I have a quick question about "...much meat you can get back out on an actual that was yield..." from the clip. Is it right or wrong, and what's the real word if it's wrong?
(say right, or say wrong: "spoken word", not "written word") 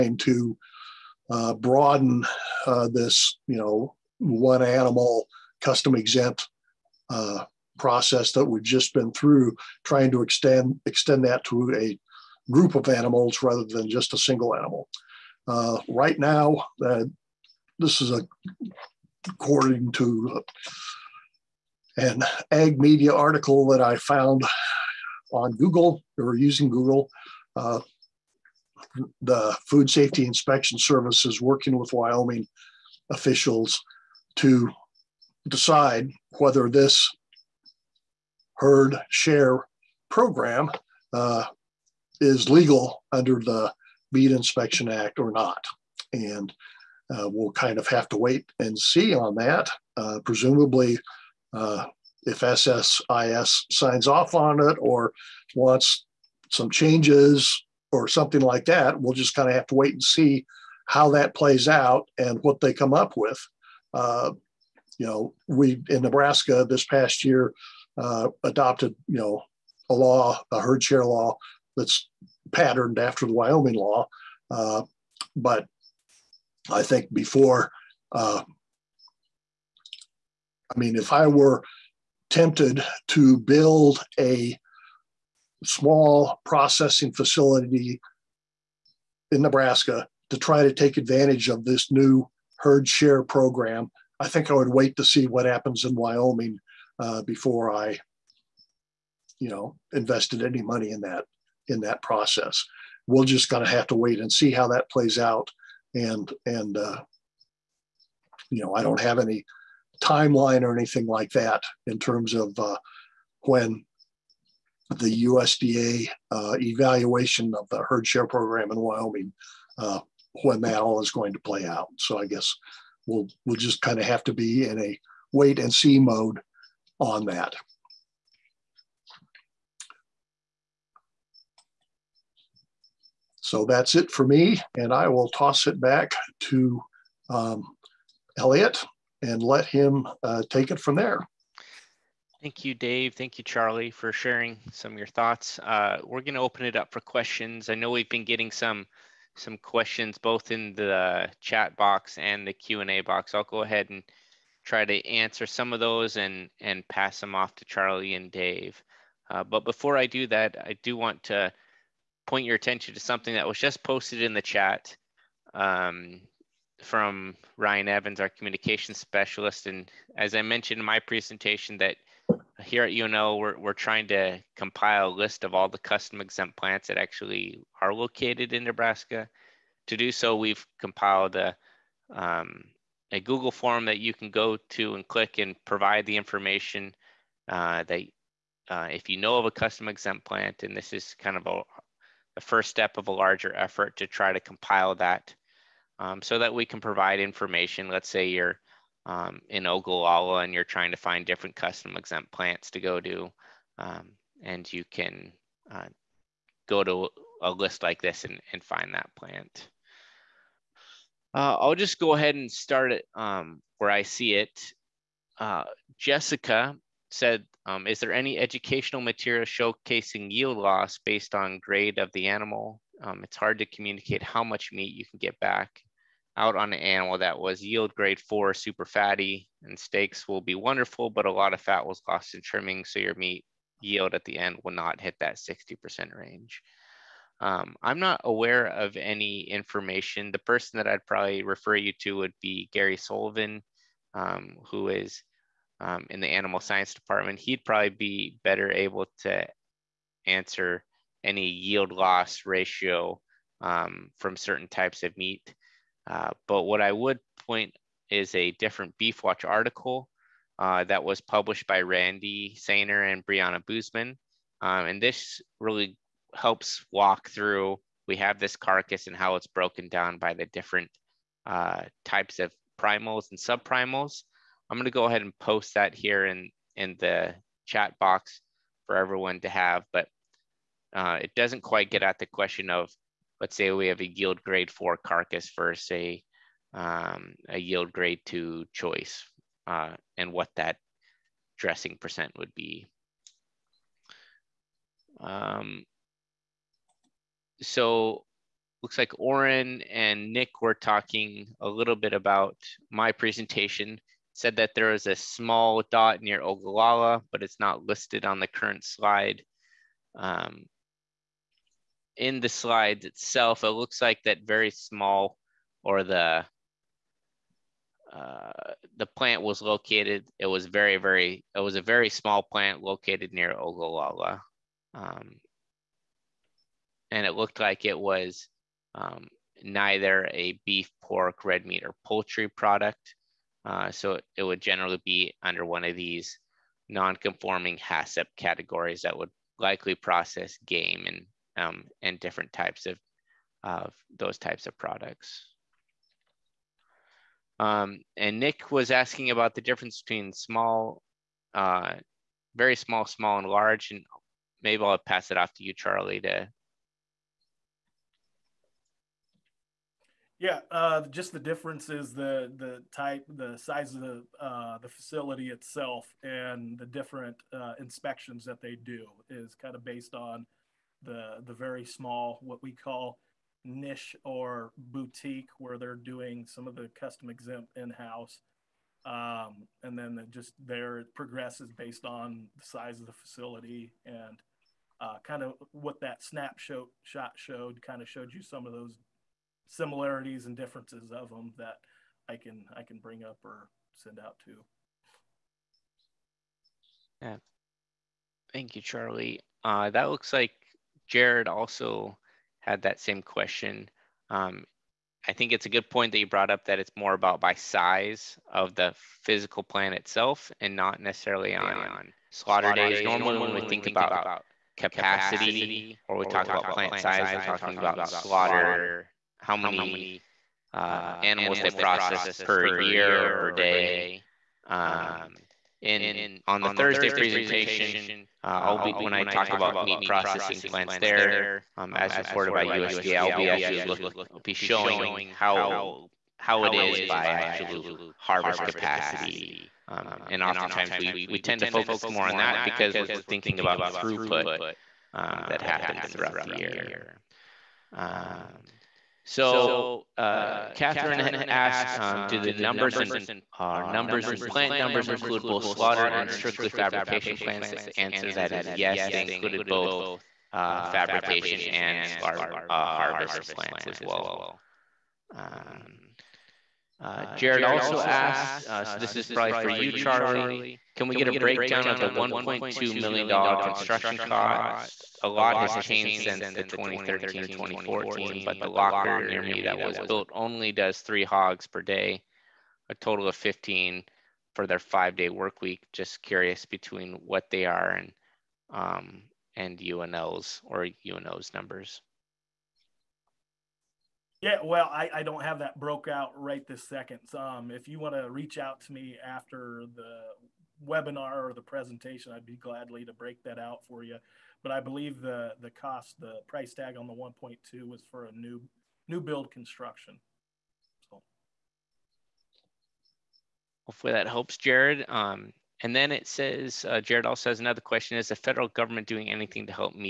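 wrong: "animal", not "actual".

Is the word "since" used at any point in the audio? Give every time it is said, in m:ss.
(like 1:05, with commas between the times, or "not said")
7:56.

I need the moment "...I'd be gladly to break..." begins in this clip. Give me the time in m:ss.
8:22.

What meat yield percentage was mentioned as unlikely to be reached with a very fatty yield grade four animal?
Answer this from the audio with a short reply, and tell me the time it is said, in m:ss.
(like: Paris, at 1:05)
60%, at 3:55.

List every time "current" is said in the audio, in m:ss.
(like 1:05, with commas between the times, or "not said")
5:08.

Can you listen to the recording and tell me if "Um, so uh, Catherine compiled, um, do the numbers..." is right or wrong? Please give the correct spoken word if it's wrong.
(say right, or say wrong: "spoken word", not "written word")
wrong: "asked", not "compiled".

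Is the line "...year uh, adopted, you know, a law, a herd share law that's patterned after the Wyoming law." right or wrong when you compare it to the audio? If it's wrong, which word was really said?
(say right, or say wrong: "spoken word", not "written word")
right.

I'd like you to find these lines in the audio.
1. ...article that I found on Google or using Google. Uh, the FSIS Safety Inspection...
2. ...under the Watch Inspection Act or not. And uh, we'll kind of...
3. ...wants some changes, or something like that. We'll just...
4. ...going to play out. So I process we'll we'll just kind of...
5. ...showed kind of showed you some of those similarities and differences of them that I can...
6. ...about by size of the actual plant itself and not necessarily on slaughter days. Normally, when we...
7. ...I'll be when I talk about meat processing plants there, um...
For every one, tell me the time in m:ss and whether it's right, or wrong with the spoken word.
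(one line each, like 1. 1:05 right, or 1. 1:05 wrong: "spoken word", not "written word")
1. 0:23 wrong: "Food", not "FSIS"
2. 0:43 wrong: "Meat", not "Watch"
3. 0:55 right
4. 2:01 wrong: "guess", not "process"
5. 6:27 right
6. 6:47 wrong: "physical", not "actual"
7. 7:08 right.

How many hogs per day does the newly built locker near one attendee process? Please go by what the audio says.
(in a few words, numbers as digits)
3.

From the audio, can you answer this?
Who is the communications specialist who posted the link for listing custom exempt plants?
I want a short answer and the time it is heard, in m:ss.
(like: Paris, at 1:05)
Ryan Evans, at 2:47.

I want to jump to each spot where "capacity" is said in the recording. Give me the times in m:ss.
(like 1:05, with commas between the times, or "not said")
6:54, 7:18.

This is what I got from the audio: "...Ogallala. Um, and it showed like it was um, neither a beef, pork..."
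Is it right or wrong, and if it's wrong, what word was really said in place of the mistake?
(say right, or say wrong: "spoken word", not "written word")
wrong: "looked", not "showed".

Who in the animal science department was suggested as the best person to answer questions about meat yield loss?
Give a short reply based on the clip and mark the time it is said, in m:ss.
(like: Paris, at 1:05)
Gary Sullivan, at 4:02.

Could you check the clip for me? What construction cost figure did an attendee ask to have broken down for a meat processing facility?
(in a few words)
$1.2 million.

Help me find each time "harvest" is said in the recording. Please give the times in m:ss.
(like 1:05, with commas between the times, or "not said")
7:18, 7:42.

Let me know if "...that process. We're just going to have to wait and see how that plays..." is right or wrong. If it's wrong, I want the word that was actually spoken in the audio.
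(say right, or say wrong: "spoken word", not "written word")
right.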